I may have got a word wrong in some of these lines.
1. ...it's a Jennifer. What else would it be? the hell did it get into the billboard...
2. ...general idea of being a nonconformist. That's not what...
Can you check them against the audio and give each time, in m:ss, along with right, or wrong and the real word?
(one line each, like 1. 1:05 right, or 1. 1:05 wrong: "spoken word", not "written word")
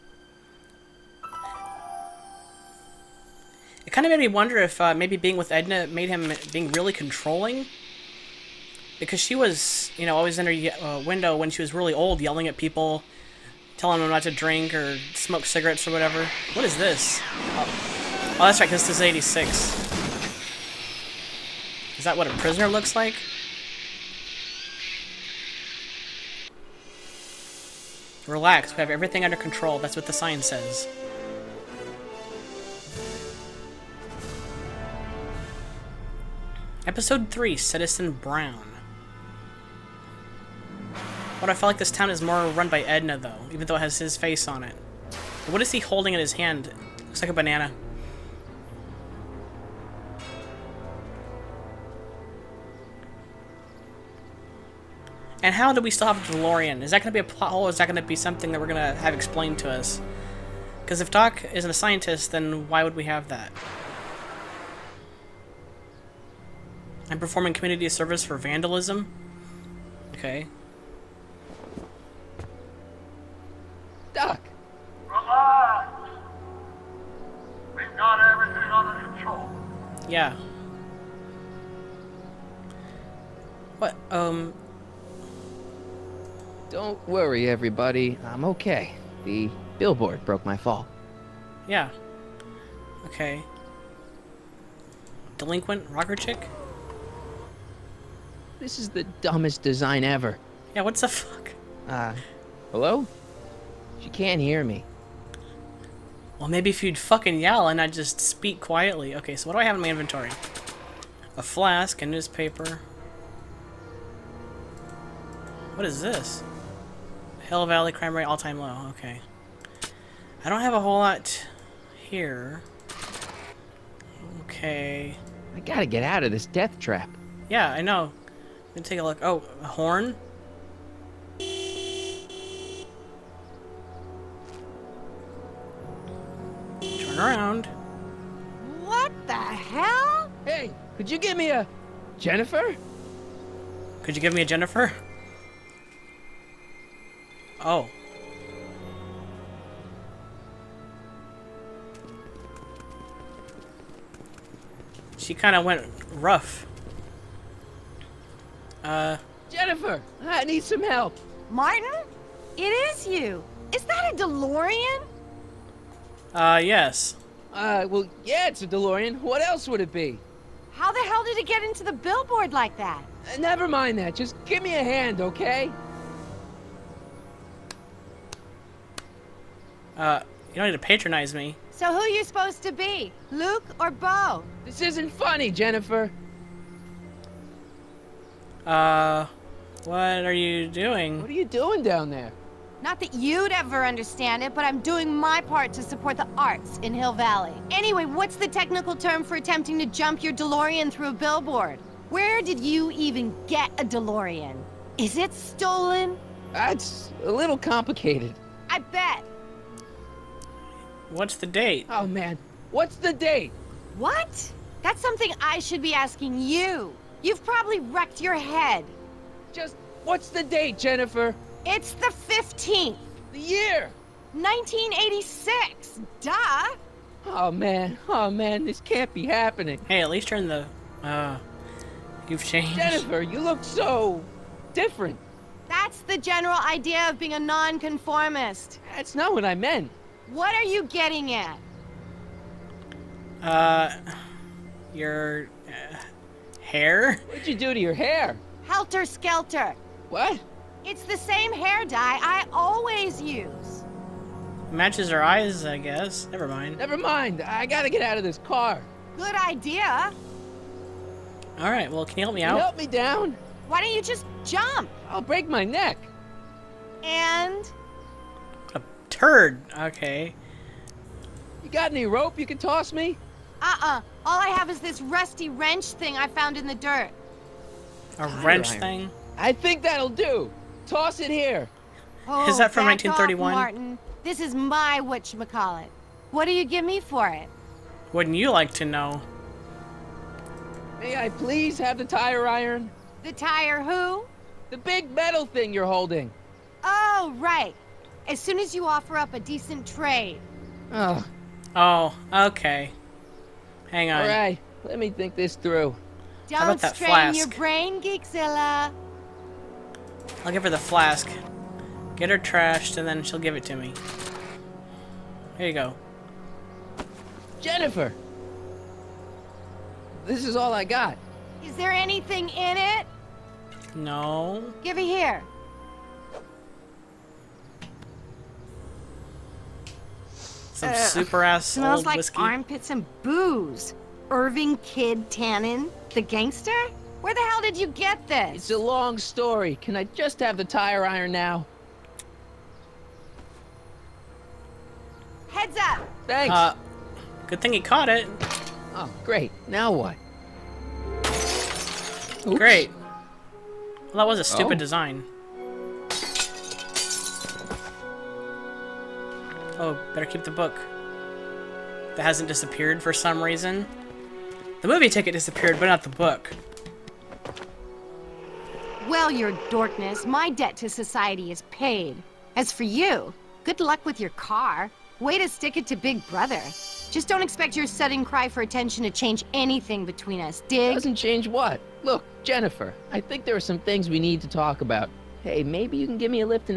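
1. 2:48 wrong: "DeLorean", not "Jennifer"
2. 3:56 right.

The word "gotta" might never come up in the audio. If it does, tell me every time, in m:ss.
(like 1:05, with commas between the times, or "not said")
2:05, 4:17.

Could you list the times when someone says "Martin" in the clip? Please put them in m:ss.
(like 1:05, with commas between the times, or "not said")
2:41, 4:43.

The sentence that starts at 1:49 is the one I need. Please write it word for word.
Okay, so what do I have in my inventory?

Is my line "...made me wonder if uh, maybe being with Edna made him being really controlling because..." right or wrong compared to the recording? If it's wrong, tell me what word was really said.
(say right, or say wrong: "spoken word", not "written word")
right.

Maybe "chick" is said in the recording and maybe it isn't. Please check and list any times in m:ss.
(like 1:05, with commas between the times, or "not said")
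1:36.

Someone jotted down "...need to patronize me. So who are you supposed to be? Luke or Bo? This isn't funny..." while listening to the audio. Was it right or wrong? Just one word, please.
right.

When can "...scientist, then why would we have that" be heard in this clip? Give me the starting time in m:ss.
1:01.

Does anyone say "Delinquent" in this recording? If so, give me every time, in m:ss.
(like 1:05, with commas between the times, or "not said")
1:35.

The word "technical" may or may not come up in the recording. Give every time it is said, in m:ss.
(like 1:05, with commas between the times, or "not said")
3:18.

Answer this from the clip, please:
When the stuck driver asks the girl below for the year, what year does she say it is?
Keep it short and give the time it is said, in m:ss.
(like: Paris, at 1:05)
1986, at 3:44.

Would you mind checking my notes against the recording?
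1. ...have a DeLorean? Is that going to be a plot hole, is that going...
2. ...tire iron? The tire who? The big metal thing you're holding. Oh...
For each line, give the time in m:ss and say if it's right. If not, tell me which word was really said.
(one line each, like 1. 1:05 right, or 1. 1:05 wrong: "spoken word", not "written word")
1. 0:56 right
2. 4:52 right.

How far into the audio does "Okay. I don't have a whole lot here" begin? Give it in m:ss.
1:58.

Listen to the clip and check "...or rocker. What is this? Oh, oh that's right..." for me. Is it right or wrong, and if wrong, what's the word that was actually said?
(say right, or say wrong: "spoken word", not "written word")
wrong: "whatever", not "rocker".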